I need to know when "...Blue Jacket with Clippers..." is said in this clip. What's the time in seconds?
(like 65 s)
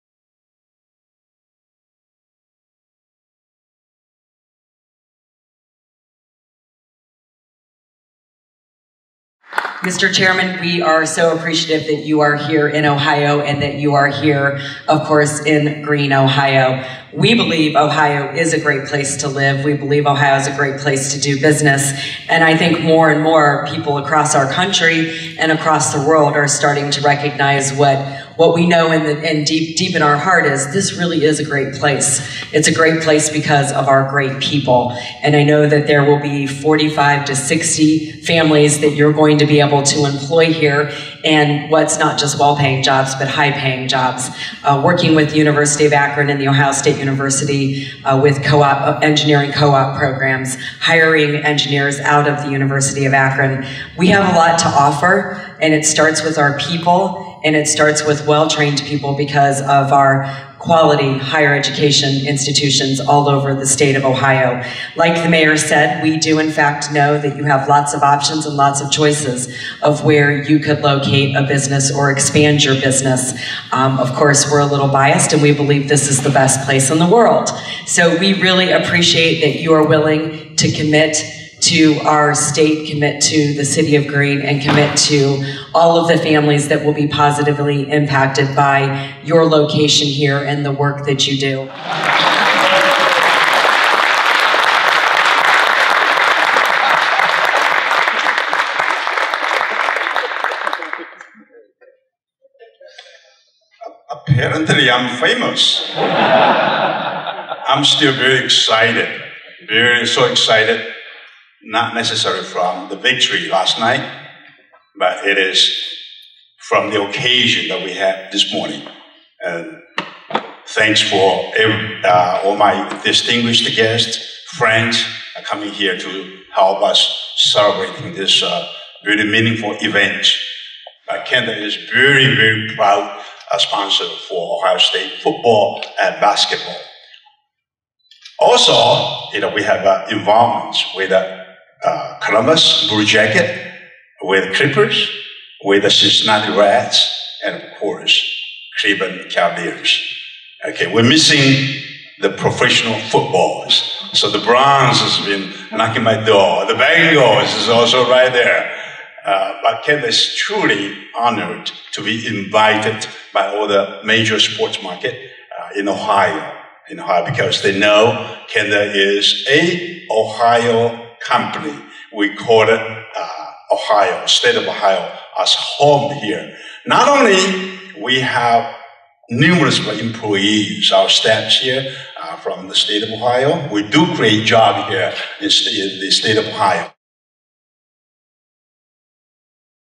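142 s.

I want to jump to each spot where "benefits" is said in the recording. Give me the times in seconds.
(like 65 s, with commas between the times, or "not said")
not said.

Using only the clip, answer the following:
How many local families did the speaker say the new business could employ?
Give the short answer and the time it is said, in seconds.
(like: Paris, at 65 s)
45 to 60, at 36 s.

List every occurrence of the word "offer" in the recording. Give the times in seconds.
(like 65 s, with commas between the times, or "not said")
54 s.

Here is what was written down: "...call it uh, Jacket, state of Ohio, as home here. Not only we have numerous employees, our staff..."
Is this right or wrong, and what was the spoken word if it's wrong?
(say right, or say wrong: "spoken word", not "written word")
wrong: "Ohio", not "Jacket".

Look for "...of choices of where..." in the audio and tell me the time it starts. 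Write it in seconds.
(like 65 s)
68 s.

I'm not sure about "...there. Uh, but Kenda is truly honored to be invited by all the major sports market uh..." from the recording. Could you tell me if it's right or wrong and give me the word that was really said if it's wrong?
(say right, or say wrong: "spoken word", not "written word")
right.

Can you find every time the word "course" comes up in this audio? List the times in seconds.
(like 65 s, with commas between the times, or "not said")
15 s, 74 s, 147 s.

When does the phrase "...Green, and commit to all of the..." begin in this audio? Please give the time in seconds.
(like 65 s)
84 s.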